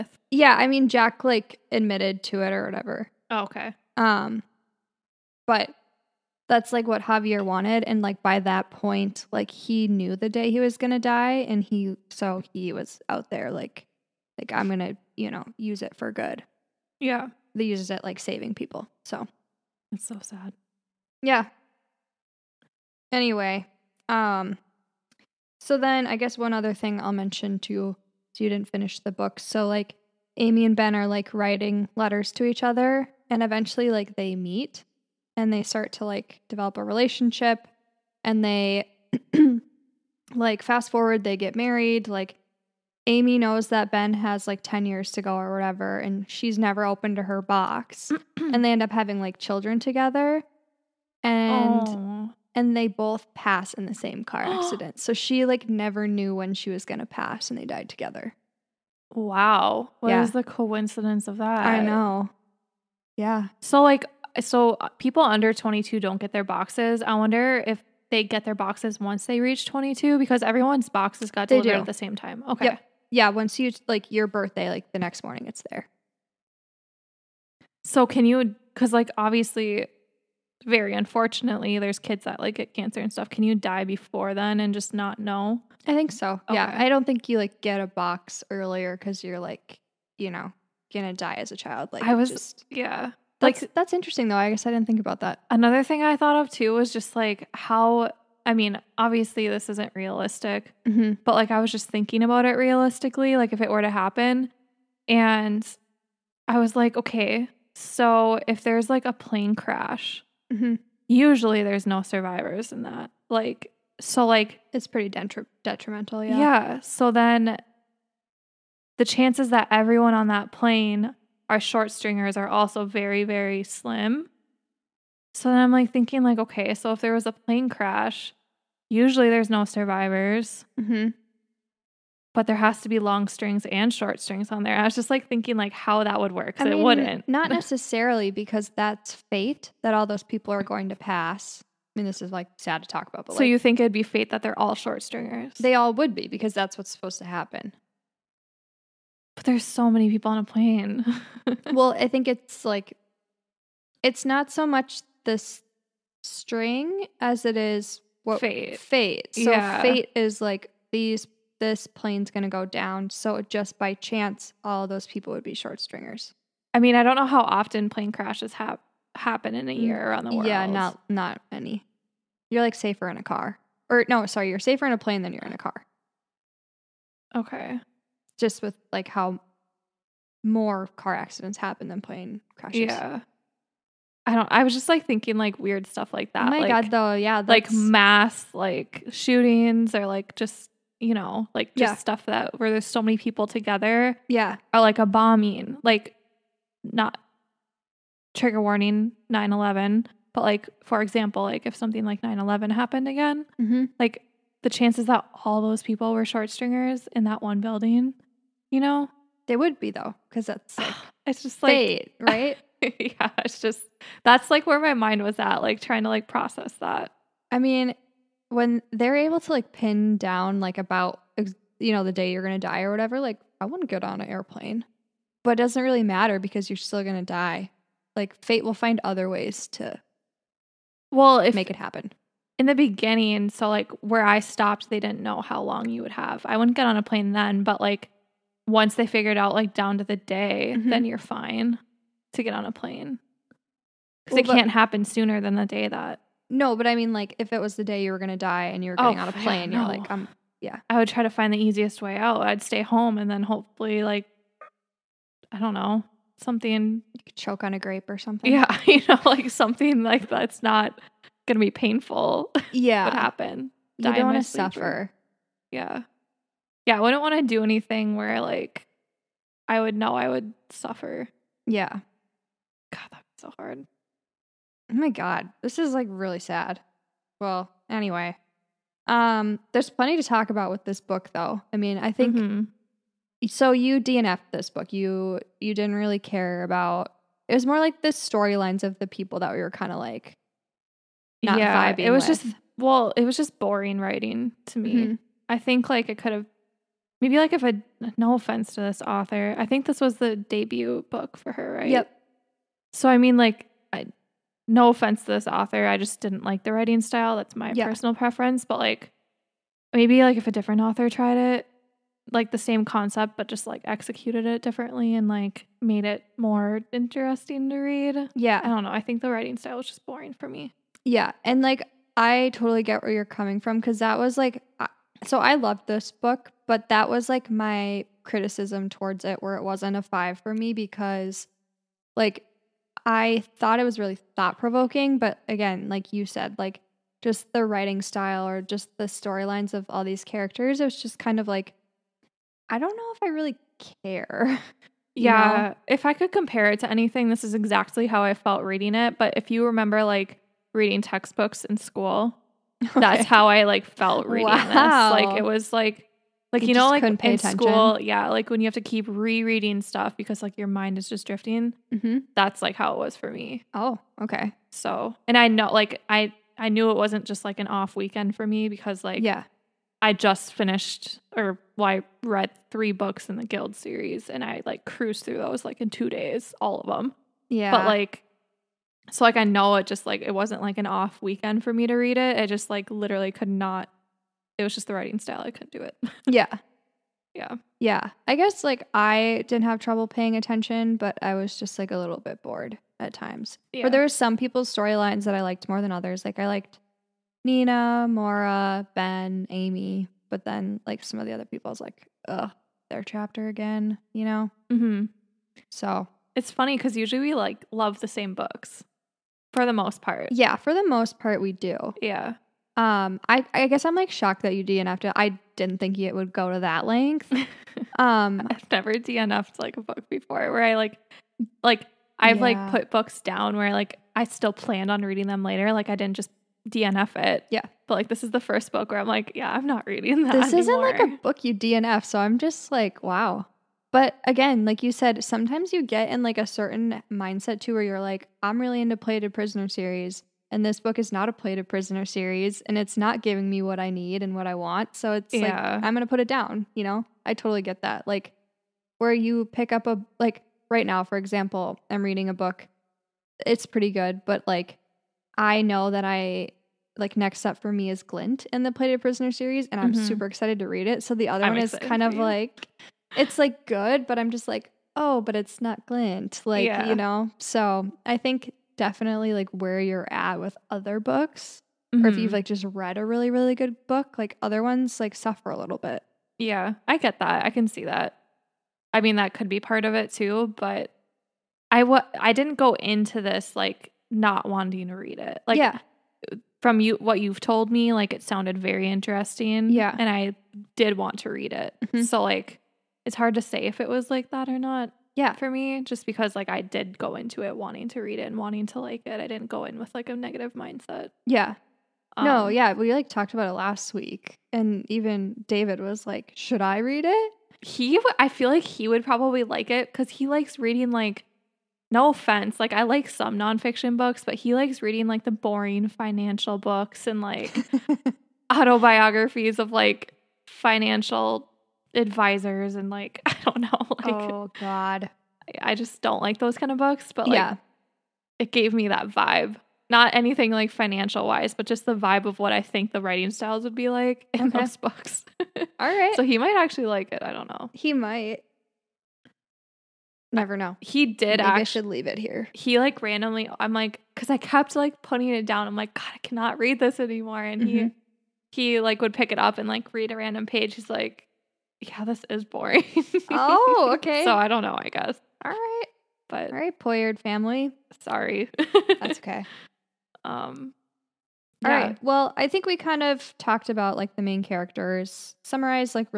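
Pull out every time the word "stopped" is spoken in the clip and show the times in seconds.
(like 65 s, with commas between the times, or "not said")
234 s.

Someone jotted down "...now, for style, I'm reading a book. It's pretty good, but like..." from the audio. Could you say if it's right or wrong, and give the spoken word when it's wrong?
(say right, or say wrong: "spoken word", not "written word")
wrong: "example", not "style".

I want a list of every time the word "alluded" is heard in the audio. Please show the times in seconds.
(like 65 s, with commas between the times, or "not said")
not said.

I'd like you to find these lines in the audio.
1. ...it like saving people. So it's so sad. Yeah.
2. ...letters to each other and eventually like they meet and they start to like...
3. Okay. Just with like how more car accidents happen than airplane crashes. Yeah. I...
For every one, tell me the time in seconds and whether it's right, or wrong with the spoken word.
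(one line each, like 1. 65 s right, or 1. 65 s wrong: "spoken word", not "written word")
1. 17 s right
2. 31 s right
3. 177 s wrong: "plane", not "airplane".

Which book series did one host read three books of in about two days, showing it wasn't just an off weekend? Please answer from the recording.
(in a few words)
Gild.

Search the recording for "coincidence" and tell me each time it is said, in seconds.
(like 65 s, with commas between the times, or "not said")
60 s.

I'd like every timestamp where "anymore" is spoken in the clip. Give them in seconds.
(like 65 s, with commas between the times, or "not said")
430 s, 547 s.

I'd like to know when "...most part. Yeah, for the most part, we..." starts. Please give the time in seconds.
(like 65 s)
409 s.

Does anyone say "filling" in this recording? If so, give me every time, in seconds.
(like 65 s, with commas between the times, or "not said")
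not said.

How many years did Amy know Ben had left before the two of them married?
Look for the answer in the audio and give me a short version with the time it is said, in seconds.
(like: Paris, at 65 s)
10, at 44 s.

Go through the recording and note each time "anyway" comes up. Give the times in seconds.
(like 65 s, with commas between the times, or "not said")
23 s, 277 s.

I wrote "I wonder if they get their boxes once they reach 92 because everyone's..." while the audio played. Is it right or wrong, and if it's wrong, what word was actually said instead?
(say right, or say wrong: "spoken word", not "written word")
wrong: "22", not "92".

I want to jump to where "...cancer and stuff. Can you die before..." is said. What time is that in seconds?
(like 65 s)
82 s.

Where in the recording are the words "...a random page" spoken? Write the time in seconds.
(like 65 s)
550 s.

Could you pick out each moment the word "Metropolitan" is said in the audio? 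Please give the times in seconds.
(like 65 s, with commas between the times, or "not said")
not said.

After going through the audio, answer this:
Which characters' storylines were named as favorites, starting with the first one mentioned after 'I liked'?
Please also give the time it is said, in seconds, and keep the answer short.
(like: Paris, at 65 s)
Nina, at 397 s.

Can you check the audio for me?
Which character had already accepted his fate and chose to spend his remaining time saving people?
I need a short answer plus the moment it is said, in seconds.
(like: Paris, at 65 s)
Javier, at 7 s.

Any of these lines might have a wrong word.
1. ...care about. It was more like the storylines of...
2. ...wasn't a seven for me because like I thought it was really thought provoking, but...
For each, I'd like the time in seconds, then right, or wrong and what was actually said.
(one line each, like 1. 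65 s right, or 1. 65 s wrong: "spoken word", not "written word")
1. 286 s right
2. 329 s wrong: "five", not "seven".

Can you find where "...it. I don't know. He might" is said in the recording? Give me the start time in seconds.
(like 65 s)
537 s.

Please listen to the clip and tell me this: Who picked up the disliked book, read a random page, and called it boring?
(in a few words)
David.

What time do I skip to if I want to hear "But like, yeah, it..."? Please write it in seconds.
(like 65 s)
527 s.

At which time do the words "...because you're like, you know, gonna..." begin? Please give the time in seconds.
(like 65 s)
88 s.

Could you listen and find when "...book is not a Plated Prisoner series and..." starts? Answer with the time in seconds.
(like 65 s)
440 s.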